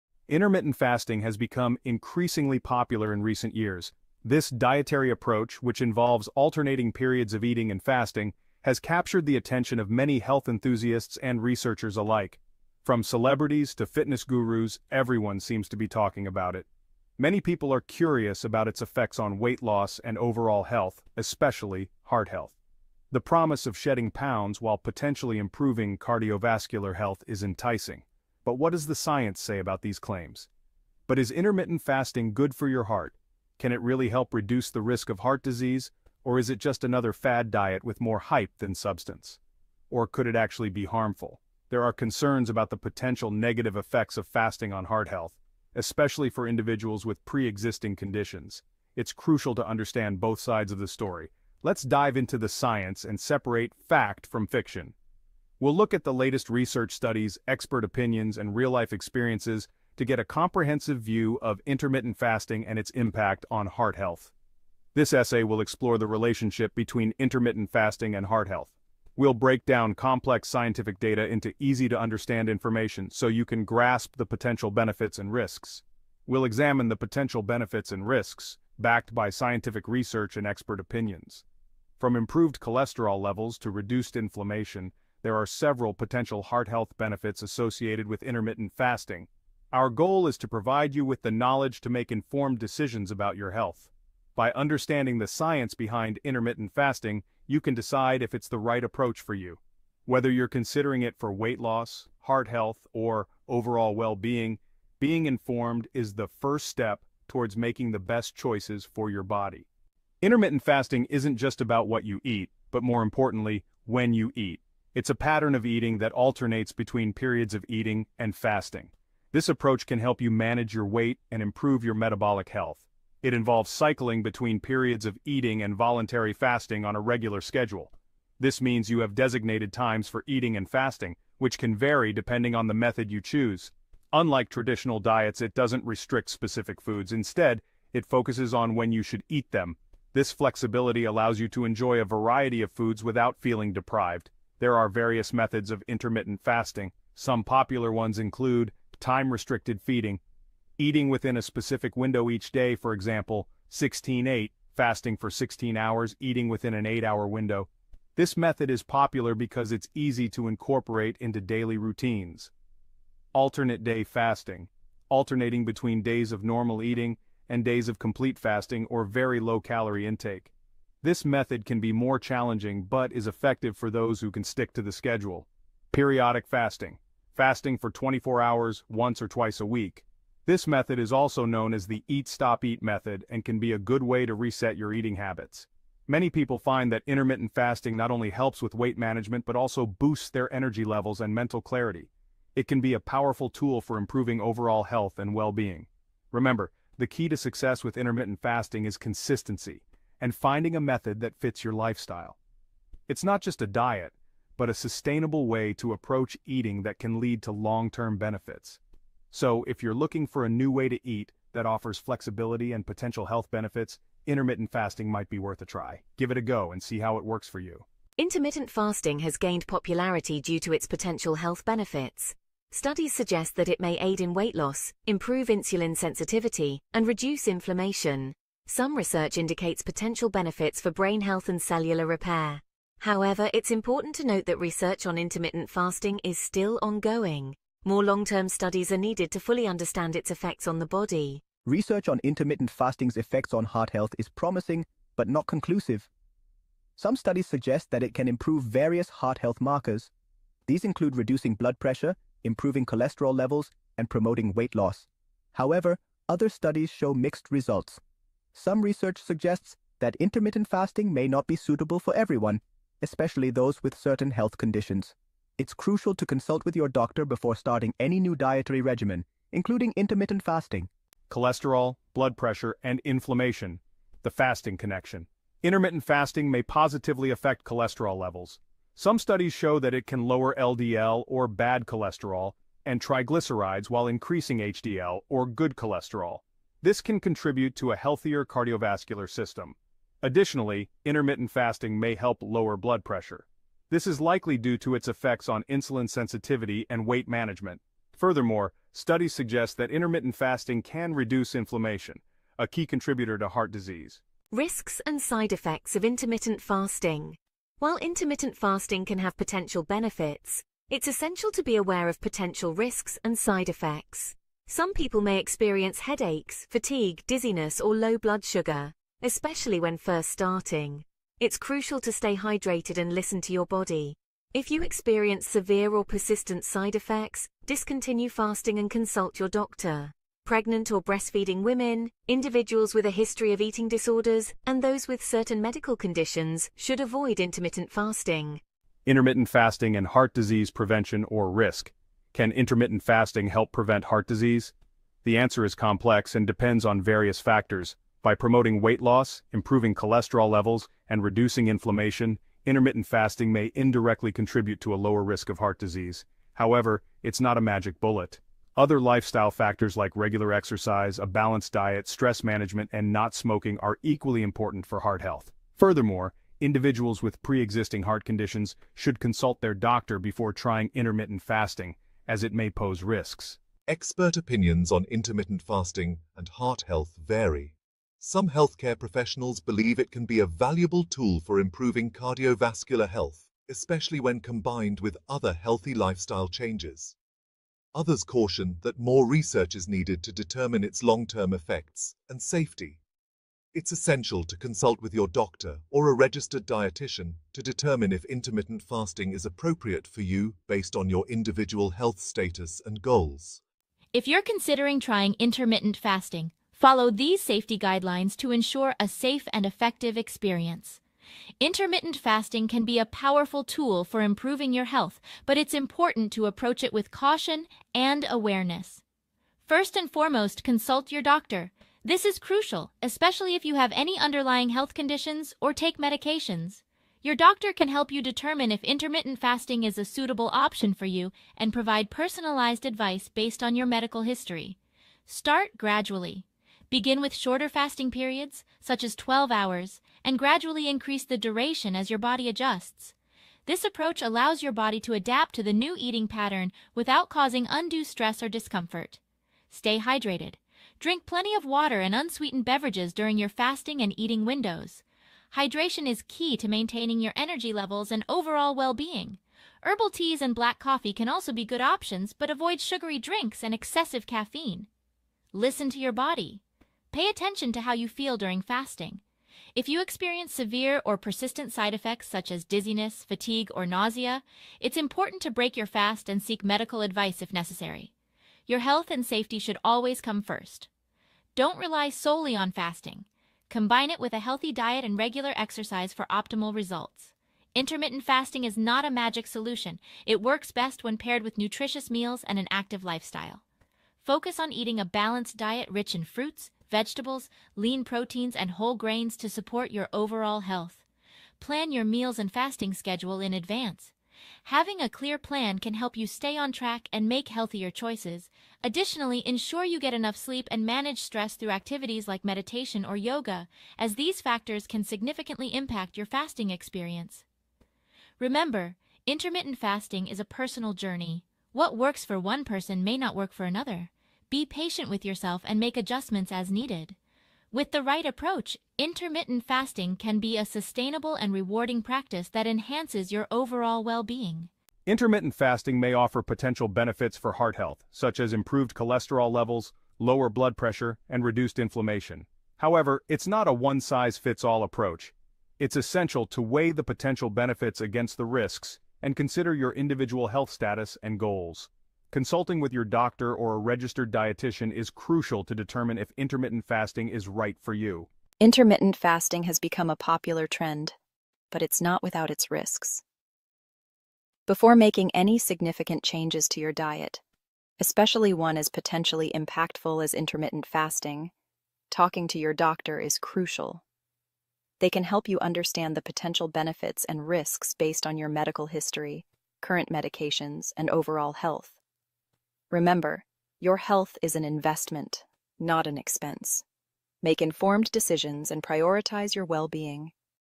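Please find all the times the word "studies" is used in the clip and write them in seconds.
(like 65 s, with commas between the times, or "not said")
56 s, 222 s, 238 s, 247 s, 256 s, 279 s, 298 s.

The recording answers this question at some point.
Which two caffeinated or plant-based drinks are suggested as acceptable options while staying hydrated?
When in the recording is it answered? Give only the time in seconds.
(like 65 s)
459 s.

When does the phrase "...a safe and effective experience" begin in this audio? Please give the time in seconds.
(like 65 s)
408 s.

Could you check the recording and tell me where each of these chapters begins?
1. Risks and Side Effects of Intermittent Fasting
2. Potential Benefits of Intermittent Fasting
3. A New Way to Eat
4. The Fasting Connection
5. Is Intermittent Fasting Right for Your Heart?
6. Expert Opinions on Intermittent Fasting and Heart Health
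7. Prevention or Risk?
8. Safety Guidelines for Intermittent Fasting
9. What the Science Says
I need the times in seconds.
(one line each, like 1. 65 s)
1. 304 s
2. 218 s
3. 109 s
4. 271 s
5. 534 s
6. 373 s
7. 338 s
8. 403 s
9. 241 s.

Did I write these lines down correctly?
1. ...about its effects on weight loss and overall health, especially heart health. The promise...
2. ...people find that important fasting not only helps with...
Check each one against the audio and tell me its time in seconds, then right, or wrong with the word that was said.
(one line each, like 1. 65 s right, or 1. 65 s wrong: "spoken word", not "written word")
1. 18 s right
2. 186 s wrong: "intermittent", not "important".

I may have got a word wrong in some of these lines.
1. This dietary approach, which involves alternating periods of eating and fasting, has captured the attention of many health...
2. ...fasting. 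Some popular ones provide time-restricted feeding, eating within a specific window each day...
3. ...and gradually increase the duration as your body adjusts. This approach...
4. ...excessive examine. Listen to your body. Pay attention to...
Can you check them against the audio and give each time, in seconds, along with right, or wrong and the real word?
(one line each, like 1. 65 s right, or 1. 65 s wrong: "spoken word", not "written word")
1. 4 s right
2. 146 s wrong: "include", not "provide"
3. 440 s right
4. 463 s wrong: "caffeine", not "examine".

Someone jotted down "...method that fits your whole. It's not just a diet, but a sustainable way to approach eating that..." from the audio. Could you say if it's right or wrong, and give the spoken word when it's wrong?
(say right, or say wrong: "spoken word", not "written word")
wrong: "lifestyle", not "whole".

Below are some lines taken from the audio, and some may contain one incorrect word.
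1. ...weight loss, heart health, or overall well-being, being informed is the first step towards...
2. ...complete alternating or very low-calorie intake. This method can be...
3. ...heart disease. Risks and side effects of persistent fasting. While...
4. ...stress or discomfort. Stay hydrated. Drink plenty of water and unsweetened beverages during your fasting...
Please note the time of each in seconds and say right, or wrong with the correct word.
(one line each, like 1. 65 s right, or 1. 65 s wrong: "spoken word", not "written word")
1. 101 s right
2. 167 s wrong: "fasting", not "alternating"
3. 303 s wrong: "intermittent", not "persistent"
4. 448 s right.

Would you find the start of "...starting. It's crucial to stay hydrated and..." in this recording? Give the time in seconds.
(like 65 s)
320 s.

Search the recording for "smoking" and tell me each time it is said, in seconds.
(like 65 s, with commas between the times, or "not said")
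363 s.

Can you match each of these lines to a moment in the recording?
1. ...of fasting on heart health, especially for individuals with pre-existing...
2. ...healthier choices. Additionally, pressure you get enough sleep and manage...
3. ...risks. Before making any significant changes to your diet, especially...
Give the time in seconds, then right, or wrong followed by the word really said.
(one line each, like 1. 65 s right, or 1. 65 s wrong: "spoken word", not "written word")
1. 44 s right
2. 507 s wrong: "ensure", not "pressure"
3. 562 s right.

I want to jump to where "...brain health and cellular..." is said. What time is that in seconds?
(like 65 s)
230 s.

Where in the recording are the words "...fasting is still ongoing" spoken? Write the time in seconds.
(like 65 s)
235 s.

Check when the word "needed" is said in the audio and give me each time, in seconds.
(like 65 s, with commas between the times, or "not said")
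238 s, 389 s, 526 s.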